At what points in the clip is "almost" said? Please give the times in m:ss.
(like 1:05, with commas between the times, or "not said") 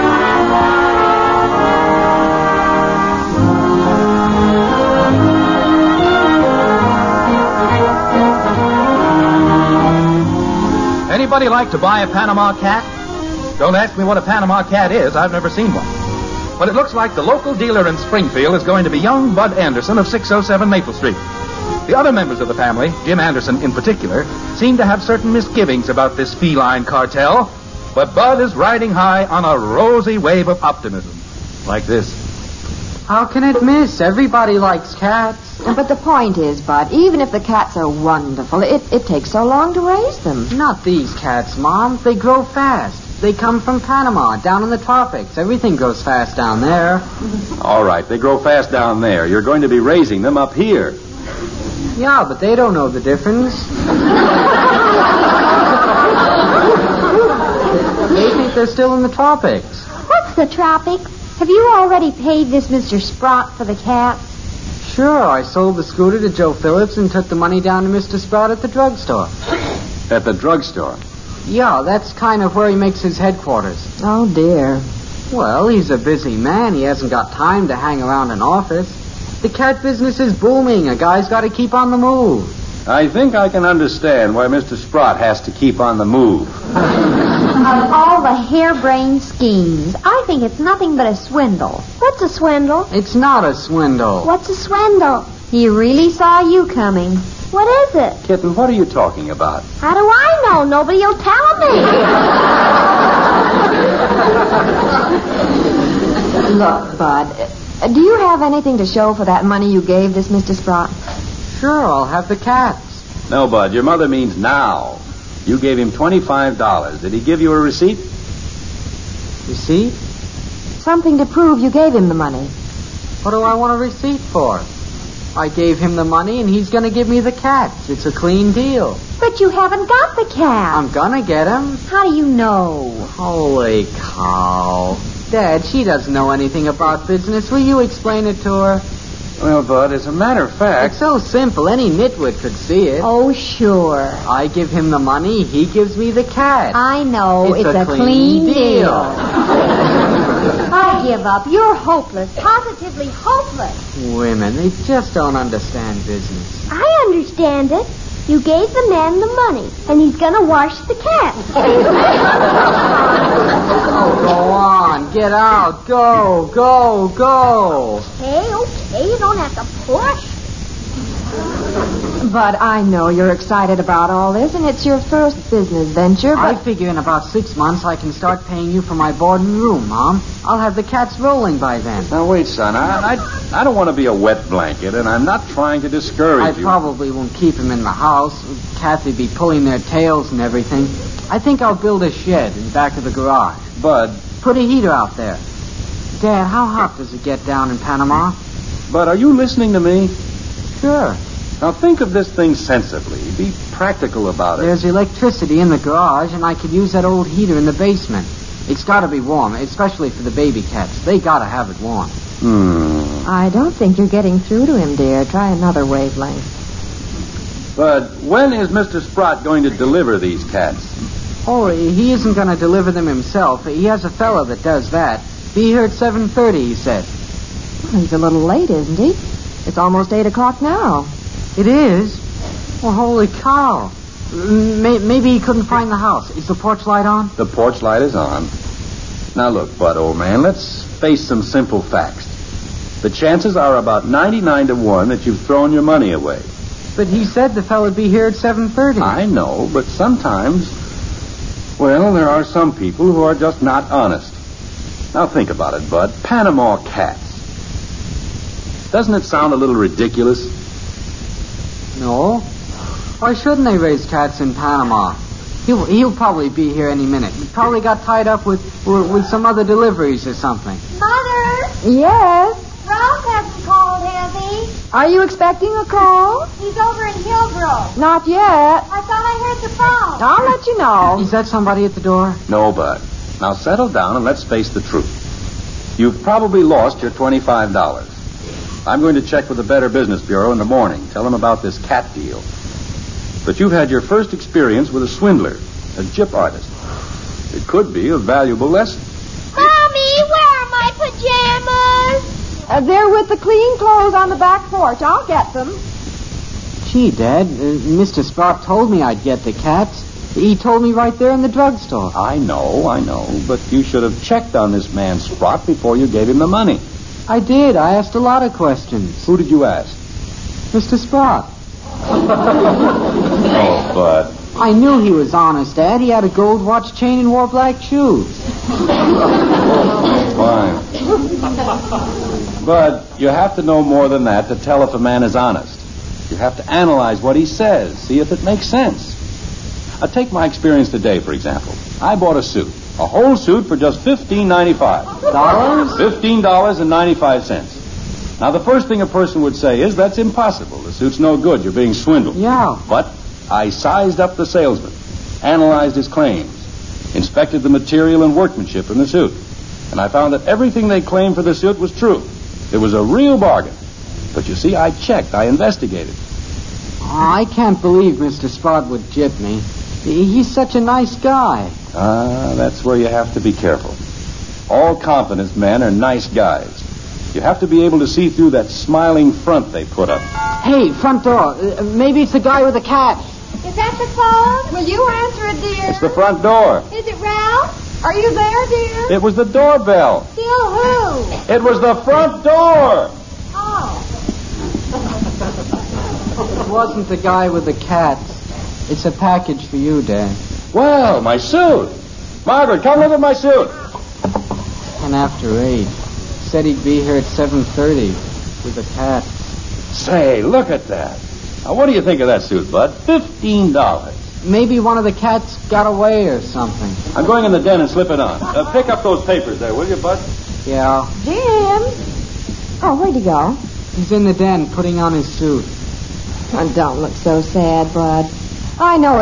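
3:49.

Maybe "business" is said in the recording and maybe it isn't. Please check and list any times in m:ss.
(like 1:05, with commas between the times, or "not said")
1:19, 2:17, 2:36, 2:55, 4:49.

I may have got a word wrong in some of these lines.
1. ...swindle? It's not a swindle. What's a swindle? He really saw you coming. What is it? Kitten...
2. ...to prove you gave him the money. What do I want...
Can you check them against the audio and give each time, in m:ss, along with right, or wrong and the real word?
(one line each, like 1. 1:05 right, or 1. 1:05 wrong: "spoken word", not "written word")
1. 1:32 right
2. 2:01 right.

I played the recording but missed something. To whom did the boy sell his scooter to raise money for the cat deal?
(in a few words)
Joe Phillips.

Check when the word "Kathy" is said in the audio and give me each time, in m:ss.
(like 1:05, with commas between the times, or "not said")
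3:08.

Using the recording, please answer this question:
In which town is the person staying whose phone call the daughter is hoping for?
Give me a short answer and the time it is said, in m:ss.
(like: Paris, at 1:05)
Hillbrook, at 4:37.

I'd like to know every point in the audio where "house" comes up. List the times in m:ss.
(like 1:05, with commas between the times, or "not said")
3:07, 3:55.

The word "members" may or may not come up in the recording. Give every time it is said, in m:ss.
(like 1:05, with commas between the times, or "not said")
0:22.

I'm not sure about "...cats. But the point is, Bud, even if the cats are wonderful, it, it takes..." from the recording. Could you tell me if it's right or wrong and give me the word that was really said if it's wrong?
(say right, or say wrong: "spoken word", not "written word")
right.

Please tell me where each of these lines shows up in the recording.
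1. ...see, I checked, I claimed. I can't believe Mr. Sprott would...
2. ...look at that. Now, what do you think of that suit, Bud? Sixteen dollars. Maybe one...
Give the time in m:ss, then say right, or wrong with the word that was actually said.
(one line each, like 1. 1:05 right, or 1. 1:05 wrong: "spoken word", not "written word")
1. 6:04 wrong: "investigated", not "claimed"
2. 6:50 wrong: "Fifteen", not "Sixteen".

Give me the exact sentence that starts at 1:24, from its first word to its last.
Sprott has to keep on the move.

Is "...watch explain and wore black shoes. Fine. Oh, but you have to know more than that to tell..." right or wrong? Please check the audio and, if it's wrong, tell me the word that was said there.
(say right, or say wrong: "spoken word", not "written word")
wrong: "chain", not "explain".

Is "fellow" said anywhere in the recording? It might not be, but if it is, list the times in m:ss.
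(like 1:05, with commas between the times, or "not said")
3:44, 4:07.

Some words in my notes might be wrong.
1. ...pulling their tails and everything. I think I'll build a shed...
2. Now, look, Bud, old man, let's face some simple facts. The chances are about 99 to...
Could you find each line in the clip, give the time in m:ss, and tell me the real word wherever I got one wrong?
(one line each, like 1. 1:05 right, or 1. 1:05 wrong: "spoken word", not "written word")
1. 3:09 right
2. 3:59 right.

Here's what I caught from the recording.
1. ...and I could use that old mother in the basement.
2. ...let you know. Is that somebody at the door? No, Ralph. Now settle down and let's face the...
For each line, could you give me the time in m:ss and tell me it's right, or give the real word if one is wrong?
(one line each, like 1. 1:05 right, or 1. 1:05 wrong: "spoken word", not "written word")
1. 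3:26 wrong: "heater", not "mother"
2. 4:40 wrong: "Bud", not "Ralph".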